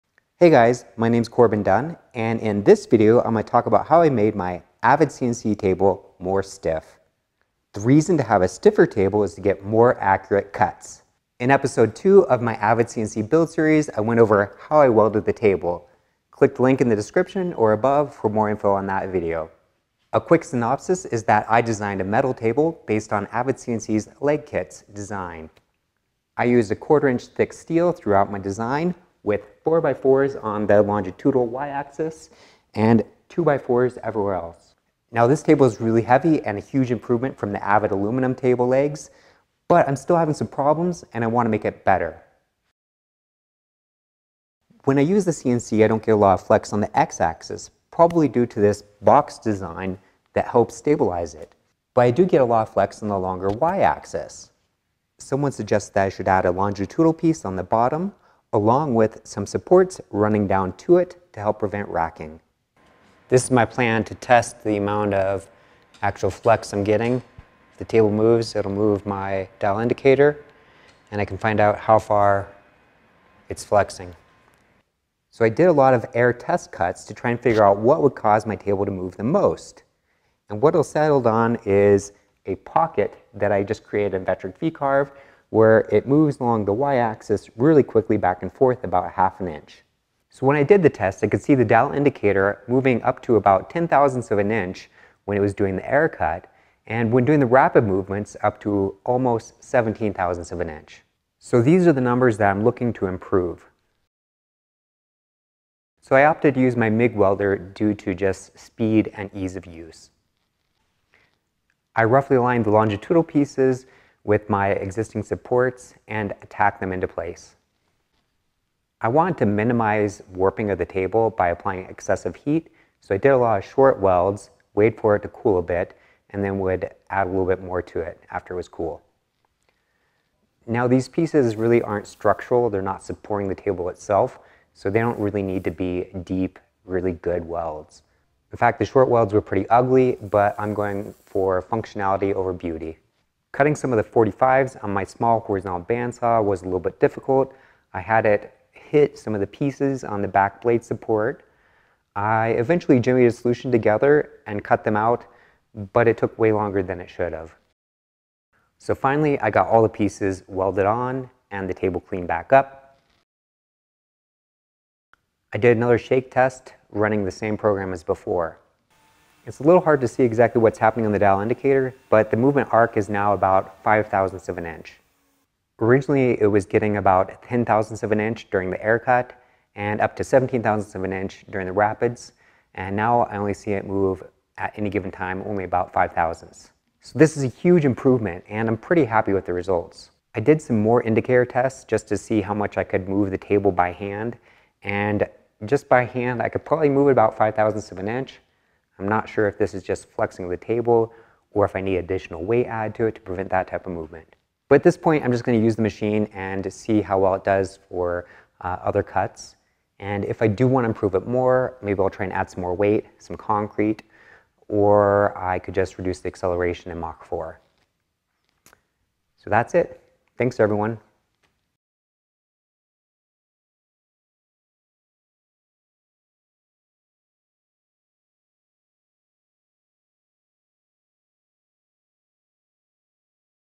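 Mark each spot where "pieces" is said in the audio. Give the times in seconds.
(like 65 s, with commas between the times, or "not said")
57 s, 113 s, 131 s, 149 s, 159 s.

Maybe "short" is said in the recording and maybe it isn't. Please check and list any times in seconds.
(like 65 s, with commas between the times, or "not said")
123 s, 138 s.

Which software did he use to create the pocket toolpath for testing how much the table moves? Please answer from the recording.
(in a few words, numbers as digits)
Vectric V-Carve.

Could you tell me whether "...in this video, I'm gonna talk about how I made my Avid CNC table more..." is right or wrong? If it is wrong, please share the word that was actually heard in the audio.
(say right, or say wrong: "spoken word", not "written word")
right.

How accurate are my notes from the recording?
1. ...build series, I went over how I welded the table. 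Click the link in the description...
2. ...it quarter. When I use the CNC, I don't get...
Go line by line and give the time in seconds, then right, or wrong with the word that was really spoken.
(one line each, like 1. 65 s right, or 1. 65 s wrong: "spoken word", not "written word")
1. 13 s right
2. 41 s wrong: "better", not "quarter".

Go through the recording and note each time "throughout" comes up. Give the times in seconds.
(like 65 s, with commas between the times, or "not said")
27 s.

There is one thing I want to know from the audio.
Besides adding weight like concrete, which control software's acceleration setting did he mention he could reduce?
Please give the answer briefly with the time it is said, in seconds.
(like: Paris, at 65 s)
Mach 4, at 216 s.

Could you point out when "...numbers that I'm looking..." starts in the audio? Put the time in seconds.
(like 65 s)
102 s.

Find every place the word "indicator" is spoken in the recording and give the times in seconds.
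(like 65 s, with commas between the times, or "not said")
69 s, 91 s, 171 s, 191 s.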